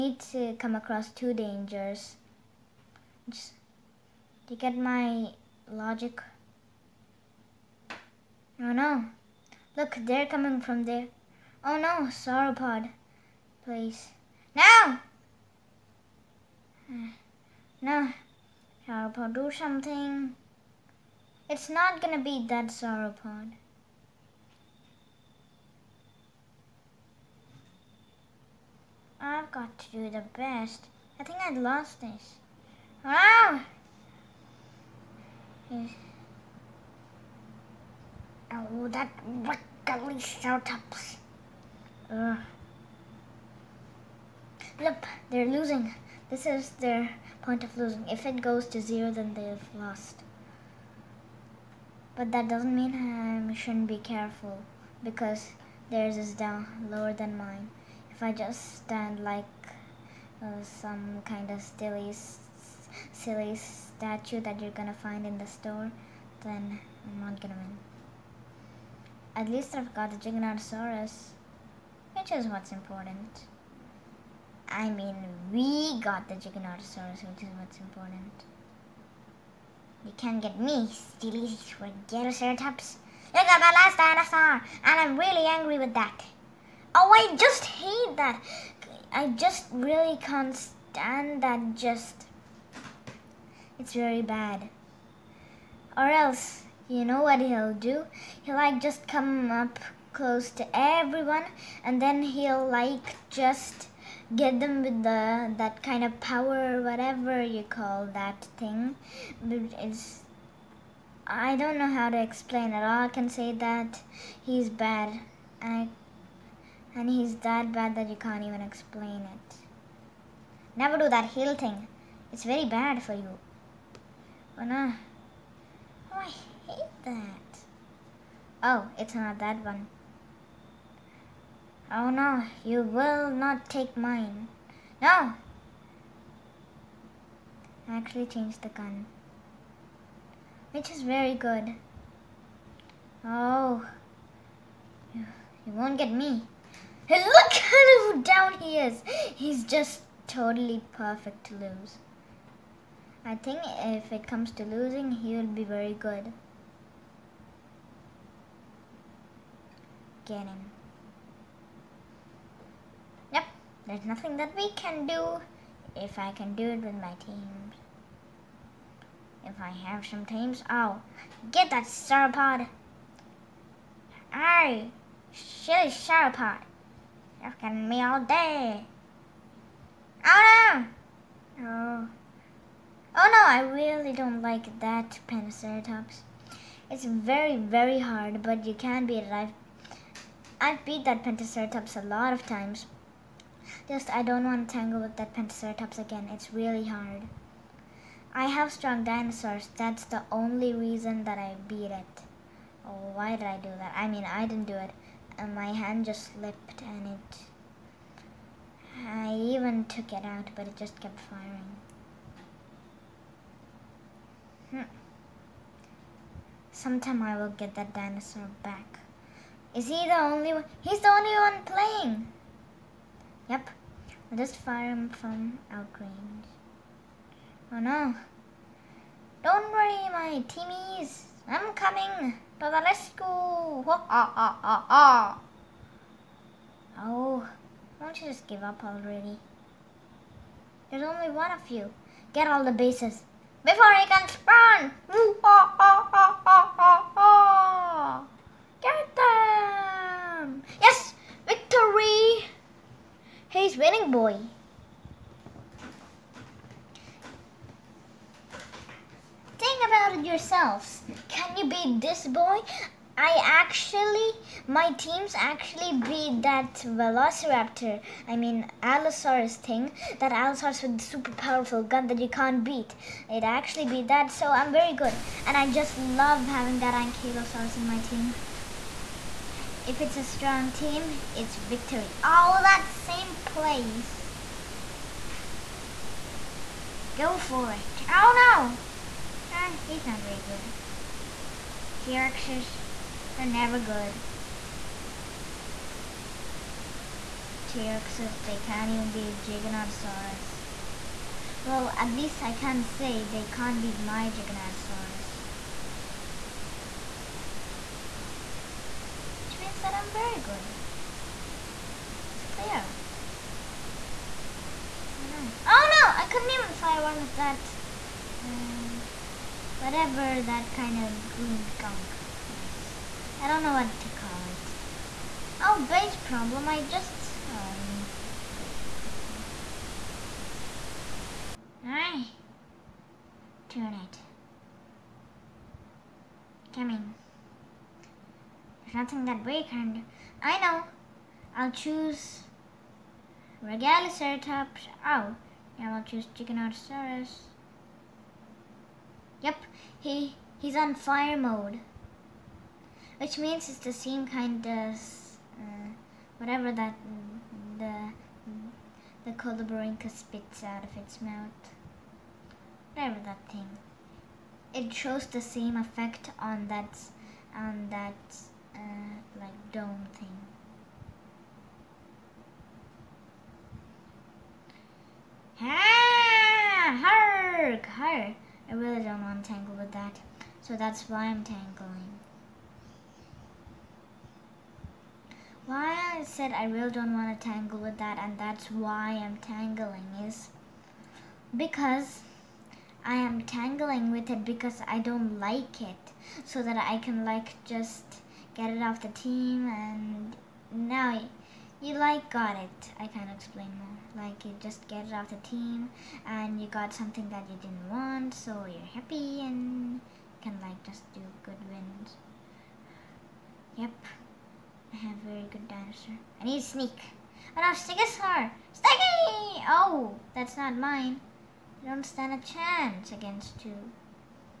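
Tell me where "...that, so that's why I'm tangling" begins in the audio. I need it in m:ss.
6:19.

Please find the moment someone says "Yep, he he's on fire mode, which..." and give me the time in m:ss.
5:49.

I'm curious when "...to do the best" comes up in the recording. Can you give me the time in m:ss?
0:29.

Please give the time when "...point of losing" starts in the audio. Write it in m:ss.
0:47.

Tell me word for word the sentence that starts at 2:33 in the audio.
I think if it comes to losing, he will be very good.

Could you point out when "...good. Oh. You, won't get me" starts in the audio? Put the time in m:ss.
2:21.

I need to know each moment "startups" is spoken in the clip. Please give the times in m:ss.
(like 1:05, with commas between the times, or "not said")
0:40.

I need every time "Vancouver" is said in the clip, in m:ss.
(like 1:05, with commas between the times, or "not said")
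not said.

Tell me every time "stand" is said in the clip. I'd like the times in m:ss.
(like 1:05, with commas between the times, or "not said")
0:58, 1:30, 7:02.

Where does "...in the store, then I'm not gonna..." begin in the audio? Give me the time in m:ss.
1:05.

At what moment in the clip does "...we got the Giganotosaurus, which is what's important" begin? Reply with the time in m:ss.
1:15.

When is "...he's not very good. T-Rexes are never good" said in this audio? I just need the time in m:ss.
4:49.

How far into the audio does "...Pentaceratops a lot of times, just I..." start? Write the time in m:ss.
3:11.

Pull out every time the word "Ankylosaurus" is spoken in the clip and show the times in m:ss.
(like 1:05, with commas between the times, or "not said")
4:36.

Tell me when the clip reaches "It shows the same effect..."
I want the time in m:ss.
6:04.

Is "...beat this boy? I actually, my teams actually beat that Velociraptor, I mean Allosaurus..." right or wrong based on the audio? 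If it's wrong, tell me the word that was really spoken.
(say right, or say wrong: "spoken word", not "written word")
right.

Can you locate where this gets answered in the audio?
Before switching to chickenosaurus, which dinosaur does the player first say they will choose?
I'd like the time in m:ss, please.
5:43.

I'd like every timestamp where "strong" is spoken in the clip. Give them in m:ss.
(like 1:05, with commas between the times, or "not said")
3:18, 4:40.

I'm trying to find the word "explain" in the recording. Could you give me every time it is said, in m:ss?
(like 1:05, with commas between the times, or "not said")
1:52, 1:58, 6:43.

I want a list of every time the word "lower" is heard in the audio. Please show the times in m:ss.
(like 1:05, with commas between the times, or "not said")
0:56.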